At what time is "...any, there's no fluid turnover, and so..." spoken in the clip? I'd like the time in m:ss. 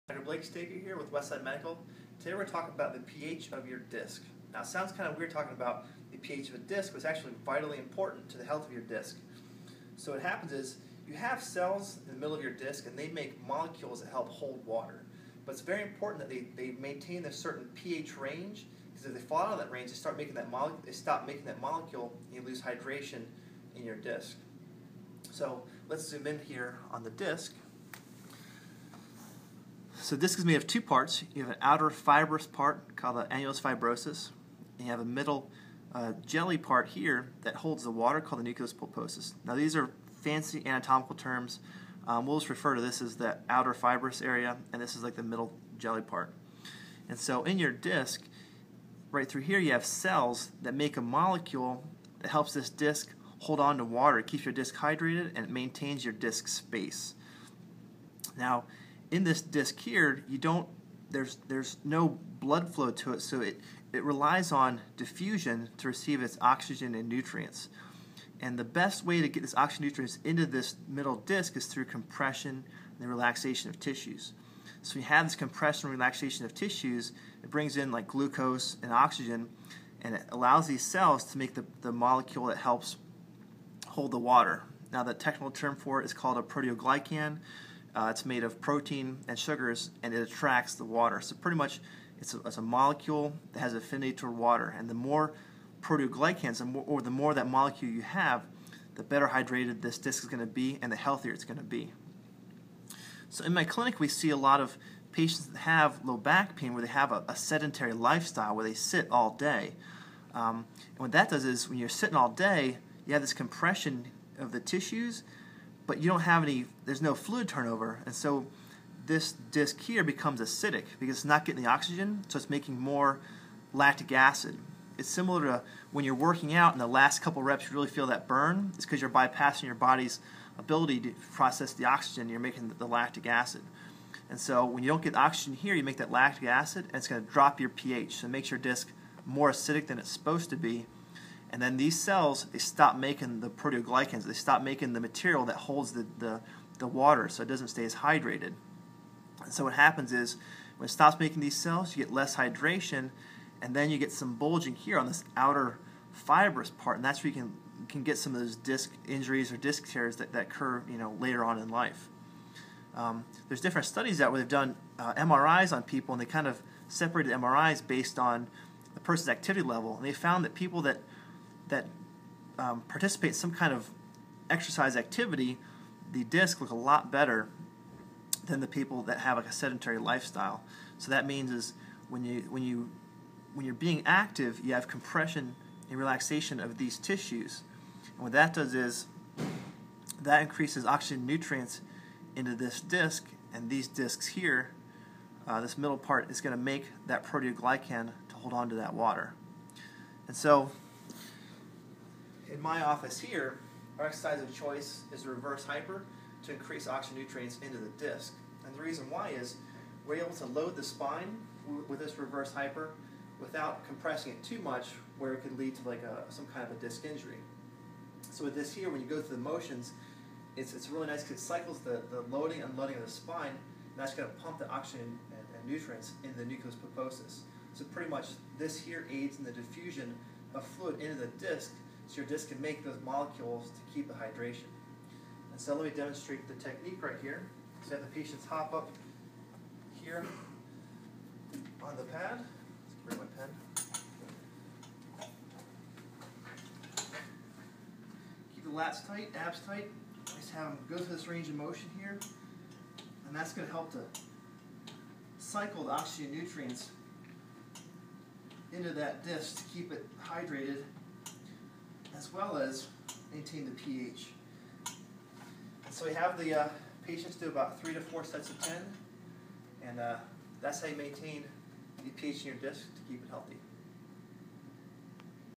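1:56.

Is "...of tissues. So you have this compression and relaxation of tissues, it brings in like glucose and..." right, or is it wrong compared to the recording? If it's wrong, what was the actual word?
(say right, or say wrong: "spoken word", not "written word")
right.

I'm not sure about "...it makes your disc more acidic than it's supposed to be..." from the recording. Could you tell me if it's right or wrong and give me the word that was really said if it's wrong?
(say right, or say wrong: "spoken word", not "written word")
right.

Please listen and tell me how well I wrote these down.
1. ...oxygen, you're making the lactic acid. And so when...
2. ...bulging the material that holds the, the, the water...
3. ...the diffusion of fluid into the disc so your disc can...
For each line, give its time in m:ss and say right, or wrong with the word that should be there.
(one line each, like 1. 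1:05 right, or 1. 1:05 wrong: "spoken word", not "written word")
1. 2:11 right
2. 2:24 wrong: "making", not "bulging"
3. 3:49 right.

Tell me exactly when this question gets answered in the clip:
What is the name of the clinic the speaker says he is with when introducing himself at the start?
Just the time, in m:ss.
0:01.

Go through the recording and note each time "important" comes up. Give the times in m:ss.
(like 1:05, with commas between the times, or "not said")
0:07, 0:15.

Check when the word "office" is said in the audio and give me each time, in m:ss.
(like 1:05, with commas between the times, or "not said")
3:22.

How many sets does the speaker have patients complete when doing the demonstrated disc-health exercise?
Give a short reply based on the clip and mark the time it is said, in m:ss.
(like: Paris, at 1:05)
3 to 4, at 4:27.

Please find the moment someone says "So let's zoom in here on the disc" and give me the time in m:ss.
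0:25.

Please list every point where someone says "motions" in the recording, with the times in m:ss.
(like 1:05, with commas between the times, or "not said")
3:39, 4:11.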